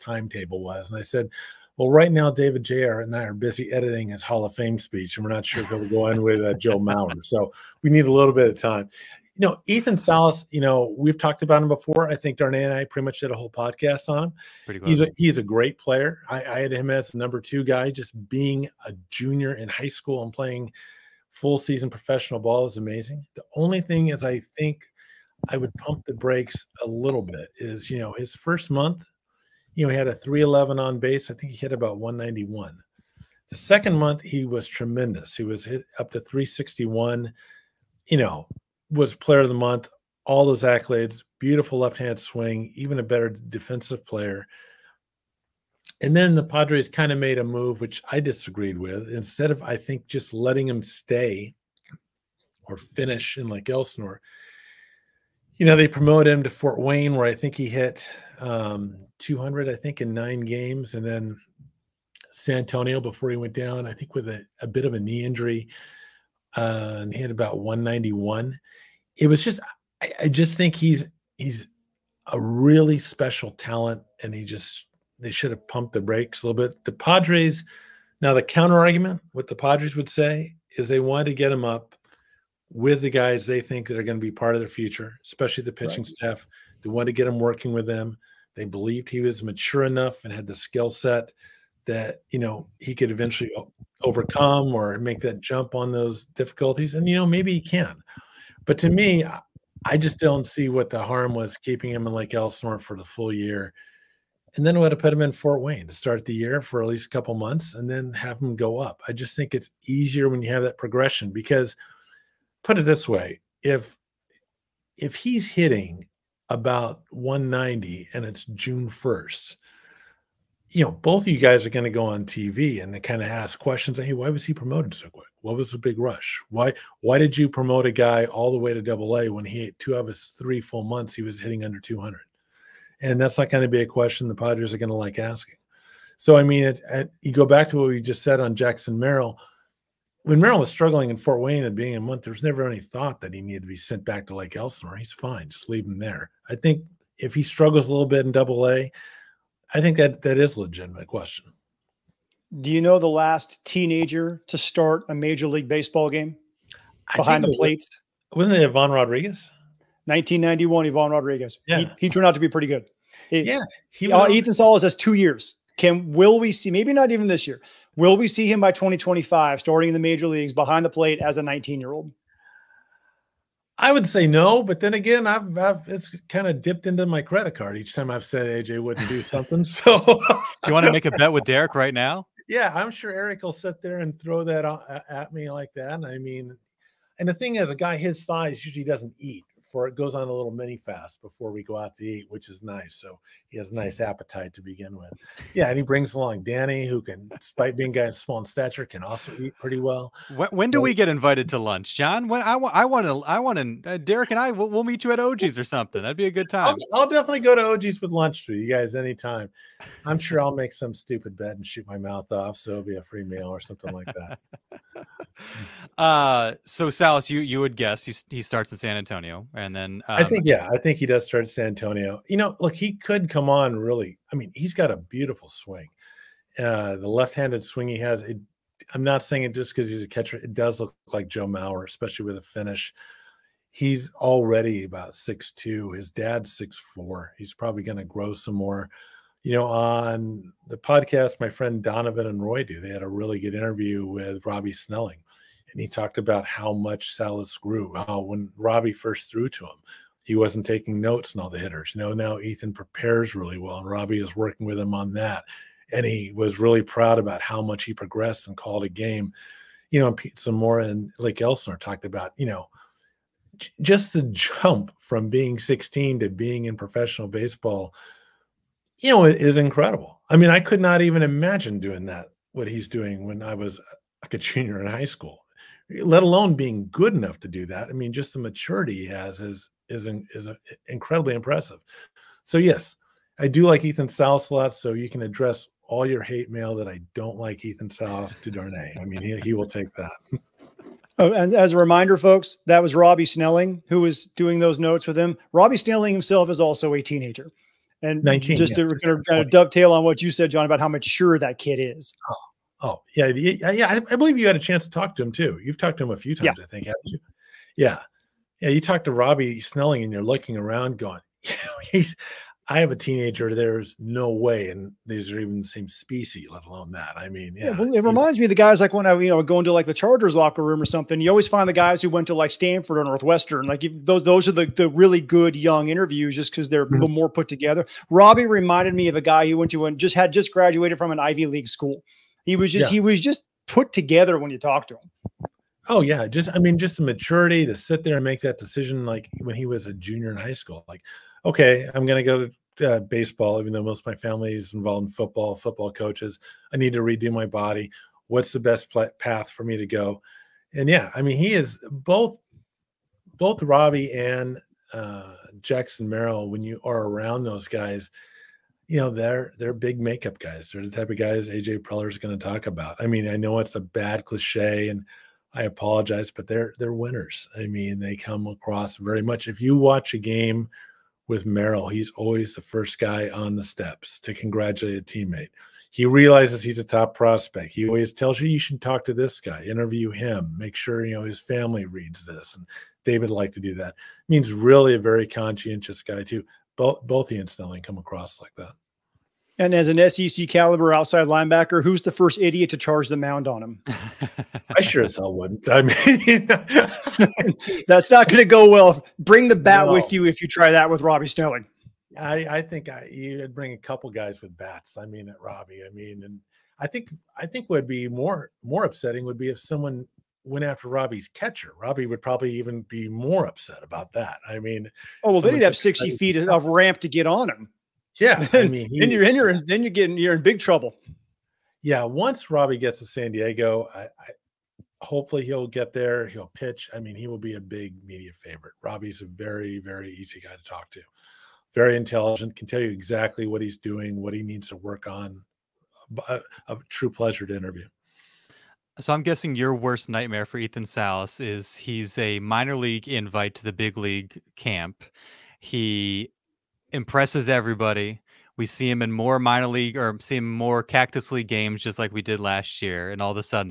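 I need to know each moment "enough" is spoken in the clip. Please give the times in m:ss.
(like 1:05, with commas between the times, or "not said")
1:29, 4:37.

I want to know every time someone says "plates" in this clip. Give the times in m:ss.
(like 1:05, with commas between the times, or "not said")
2:37, 2:50.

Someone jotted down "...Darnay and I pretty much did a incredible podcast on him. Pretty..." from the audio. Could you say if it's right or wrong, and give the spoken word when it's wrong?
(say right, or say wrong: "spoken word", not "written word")
wrong: "whole", not "incredible".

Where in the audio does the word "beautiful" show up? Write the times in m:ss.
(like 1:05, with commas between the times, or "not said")
0:41, 3:44.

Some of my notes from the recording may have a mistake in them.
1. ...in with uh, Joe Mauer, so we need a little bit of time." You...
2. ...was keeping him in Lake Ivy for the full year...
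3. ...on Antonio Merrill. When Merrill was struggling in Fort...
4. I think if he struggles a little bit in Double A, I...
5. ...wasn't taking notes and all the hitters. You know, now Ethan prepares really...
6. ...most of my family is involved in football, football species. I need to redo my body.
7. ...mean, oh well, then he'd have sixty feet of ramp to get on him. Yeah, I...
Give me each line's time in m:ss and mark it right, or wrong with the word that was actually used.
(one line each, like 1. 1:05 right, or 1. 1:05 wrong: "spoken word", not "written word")
1. 0:06 right
2. 1:41 wrong: "Elsinore", not "Ivy"
3. 2:18 wrong: "Jackson", not "Antonio"
4. 2:26 right
5. 4:10 right
6. 5:43 wrong: "coaches", not "species"
7. 6:54 right.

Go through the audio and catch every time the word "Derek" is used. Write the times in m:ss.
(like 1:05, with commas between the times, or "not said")
3:01, 3:23.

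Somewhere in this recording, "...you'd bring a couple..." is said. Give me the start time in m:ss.
6:43.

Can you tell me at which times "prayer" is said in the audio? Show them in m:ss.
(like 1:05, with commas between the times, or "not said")
not said.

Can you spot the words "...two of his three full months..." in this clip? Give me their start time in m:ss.
2:09.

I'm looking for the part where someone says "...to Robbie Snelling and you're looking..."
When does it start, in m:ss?
5:09.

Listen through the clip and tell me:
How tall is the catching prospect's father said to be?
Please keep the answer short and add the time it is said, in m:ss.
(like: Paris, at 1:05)
6'4", at 3:55.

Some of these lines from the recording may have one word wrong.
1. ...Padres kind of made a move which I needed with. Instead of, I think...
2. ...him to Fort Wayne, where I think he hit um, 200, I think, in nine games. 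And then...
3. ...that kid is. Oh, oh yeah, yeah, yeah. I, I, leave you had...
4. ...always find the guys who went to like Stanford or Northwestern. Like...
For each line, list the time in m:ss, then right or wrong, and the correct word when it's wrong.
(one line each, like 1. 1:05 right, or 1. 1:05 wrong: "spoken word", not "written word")
1. 0:46 wrong: "disagreed", not "needed"
2. 0:56 right
3. 5:01 wrong: "believe", not "leave"
4. 5:21 right.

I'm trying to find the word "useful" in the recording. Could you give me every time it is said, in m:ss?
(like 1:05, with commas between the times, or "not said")
not said.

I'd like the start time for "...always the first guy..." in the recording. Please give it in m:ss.
6:12.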